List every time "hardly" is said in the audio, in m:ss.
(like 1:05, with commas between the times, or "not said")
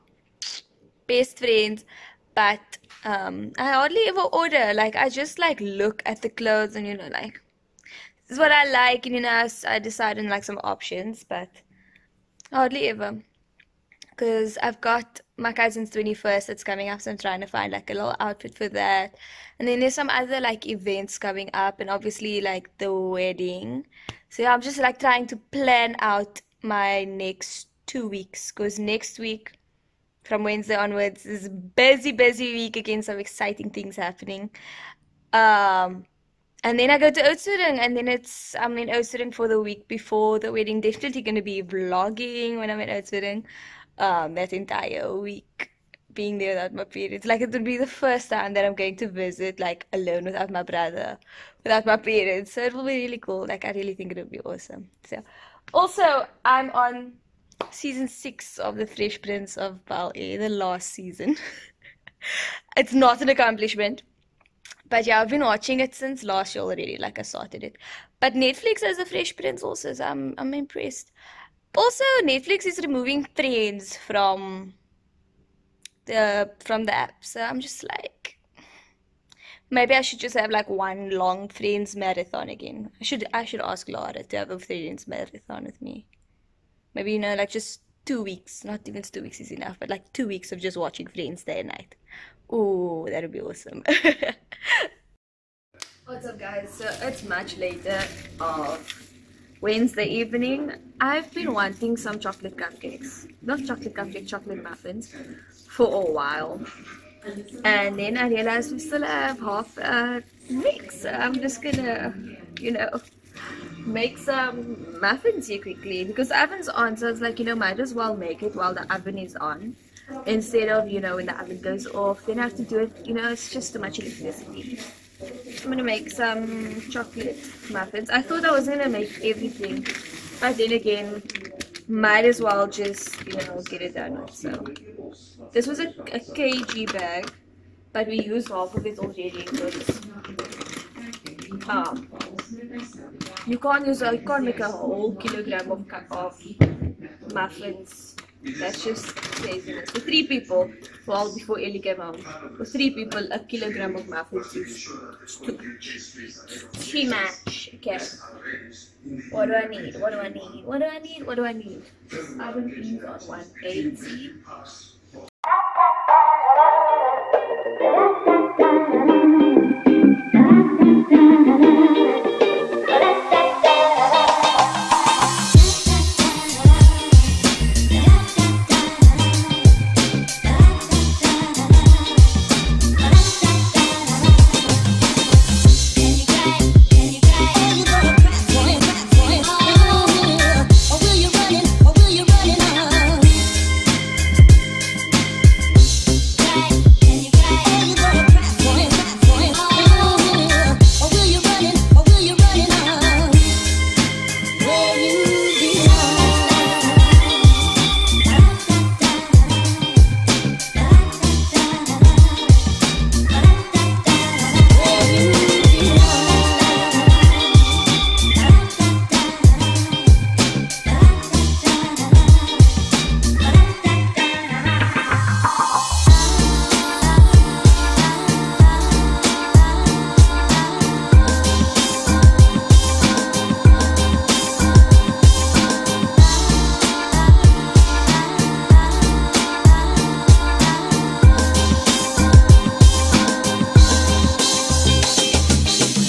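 0:03, 0:12.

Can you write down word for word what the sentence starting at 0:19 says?
And then there's some other like events coming up, and obviously like the wedding.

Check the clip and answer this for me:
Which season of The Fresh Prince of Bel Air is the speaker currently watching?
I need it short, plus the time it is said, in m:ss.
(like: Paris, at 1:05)
6, at 0:57.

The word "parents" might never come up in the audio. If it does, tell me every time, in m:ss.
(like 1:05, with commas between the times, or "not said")
0:46, 0:51.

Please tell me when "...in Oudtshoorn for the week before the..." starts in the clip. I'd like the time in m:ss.
0:38.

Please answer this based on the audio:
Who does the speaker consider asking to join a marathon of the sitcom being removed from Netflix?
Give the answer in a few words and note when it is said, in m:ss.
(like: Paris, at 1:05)
Laura, at 1:23.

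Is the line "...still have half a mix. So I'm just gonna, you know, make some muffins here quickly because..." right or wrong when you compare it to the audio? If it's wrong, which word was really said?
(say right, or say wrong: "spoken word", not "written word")
right.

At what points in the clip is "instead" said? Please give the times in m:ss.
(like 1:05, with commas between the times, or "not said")
2:00.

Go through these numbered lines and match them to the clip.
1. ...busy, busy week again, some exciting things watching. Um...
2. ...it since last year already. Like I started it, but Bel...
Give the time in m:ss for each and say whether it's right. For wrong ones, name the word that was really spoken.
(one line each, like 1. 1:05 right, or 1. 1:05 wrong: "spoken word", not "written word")
1. 0:31 wrong: "happening", not "watching"
2. 1:05 wrong: "Netflix", not "Bel".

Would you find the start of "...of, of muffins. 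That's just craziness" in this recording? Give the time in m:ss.
2:25.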